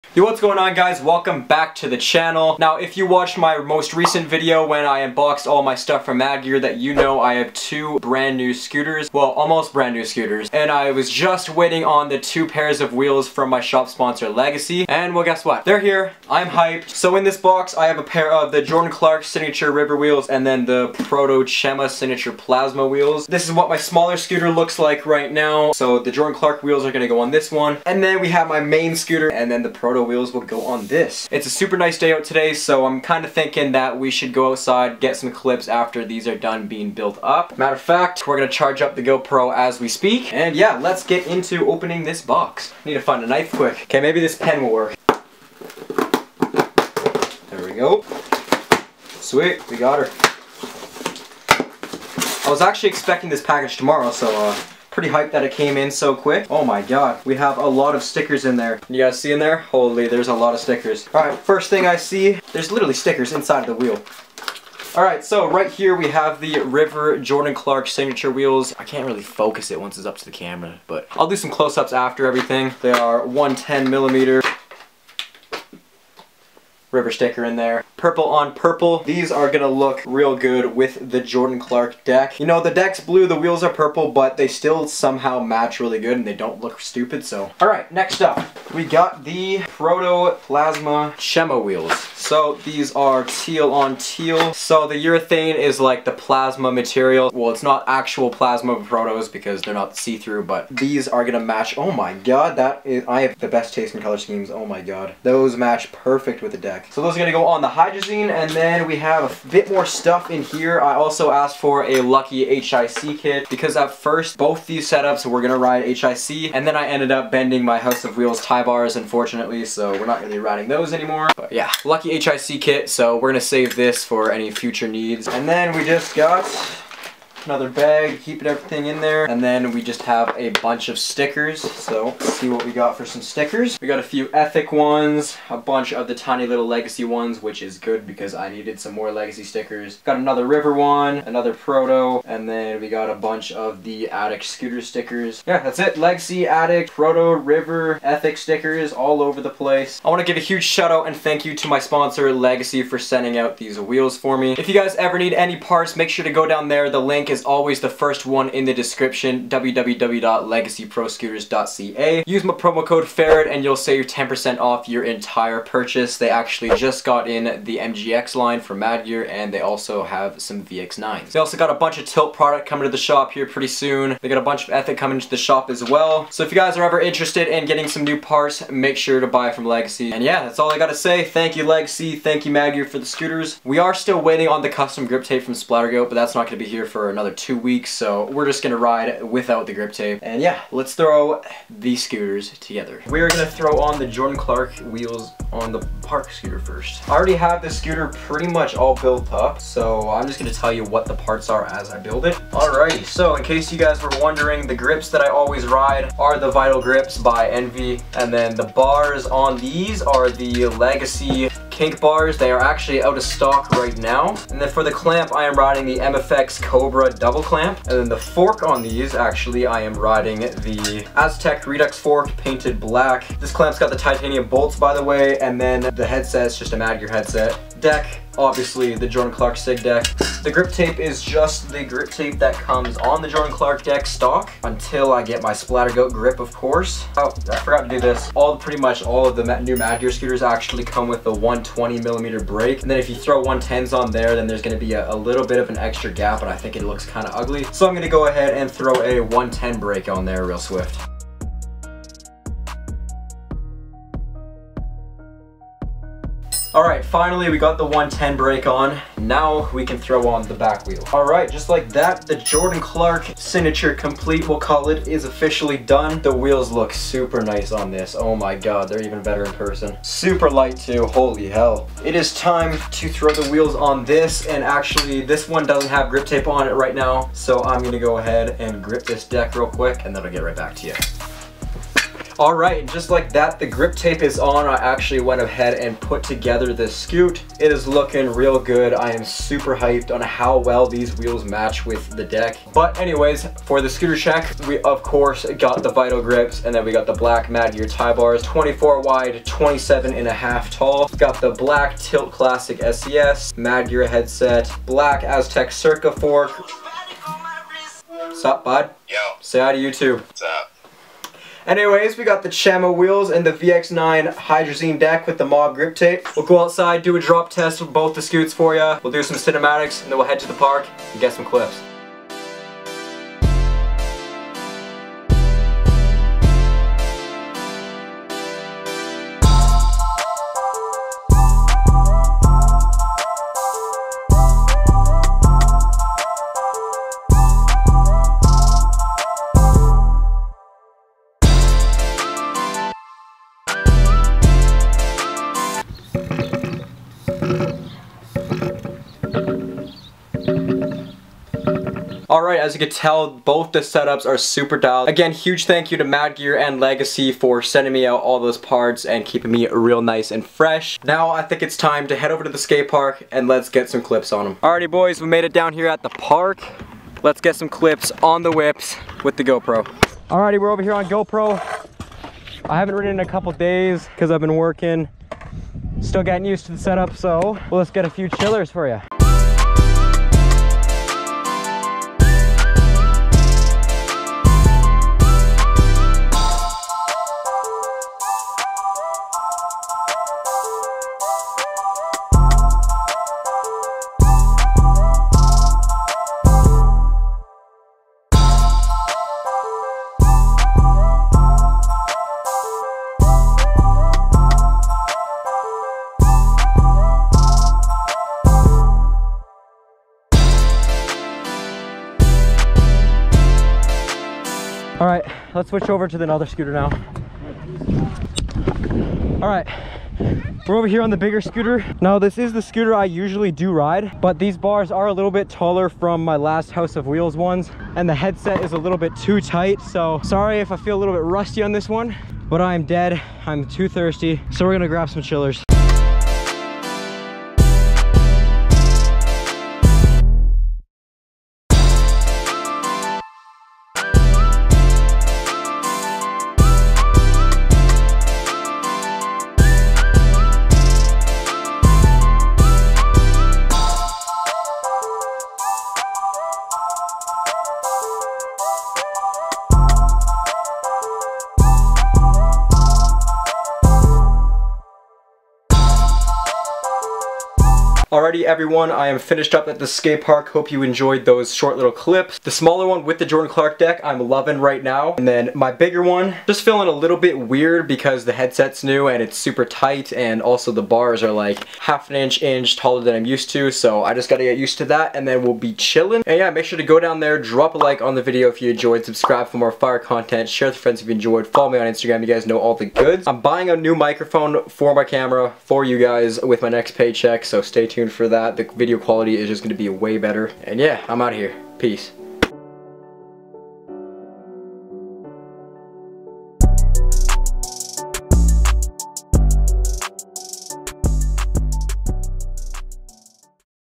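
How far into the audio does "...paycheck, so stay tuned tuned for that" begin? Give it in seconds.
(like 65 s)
496 s.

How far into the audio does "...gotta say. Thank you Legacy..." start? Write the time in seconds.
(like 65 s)
180 s.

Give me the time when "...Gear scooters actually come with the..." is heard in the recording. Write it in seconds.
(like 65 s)
240 s.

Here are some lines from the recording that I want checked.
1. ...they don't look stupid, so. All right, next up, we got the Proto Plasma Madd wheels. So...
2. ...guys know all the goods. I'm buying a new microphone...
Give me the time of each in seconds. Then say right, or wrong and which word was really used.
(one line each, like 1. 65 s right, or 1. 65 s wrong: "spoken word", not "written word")
1. 86 s wrong: "Chema", not "Madd"
2. 492 s right.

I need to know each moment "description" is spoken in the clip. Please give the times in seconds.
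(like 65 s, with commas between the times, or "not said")
158 s.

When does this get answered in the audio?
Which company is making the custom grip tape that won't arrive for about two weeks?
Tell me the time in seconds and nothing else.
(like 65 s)
185 s.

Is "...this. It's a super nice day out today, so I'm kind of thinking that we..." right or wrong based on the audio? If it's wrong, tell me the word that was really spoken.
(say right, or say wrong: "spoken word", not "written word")
right.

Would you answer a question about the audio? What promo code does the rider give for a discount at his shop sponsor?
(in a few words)
FERRET.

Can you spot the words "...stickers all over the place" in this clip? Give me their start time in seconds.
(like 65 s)
148 s.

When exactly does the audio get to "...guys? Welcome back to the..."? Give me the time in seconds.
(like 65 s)
0 s.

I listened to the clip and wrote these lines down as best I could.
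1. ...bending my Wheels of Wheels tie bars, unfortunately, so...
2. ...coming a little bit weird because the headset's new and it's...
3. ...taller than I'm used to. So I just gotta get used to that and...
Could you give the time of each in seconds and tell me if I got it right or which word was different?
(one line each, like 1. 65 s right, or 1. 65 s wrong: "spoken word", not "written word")
1. 117 s wrong: "House", not "Wheels"
2. 476 s wrong: "feeling", not "coming"
3. 482 s right.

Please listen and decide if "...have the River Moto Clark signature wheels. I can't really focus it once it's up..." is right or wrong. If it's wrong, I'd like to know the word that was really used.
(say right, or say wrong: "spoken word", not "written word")
wrong: "Jordan", not "Moto".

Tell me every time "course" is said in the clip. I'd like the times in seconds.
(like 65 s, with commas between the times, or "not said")
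236 s, 295 s.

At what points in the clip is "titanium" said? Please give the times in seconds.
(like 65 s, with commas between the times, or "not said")
223 s.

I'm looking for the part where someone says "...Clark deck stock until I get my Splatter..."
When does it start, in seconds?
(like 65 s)
233 s.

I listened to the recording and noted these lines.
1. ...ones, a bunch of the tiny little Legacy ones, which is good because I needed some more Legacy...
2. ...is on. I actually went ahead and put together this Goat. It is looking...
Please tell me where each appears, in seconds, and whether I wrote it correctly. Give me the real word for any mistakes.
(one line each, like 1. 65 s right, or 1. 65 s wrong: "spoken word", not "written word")
1. 134 s right
2. 284 s wrong: "Scoot", not "Goat".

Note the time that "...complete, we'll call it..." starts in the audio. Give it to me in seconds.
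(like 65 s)
263 s.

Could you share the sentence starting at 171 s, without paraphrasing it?
They also got a bunch of Tilt product coming to the shop here pretty soon.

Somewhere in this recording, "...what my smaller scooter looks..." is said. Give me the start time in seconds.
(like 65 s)
23 s.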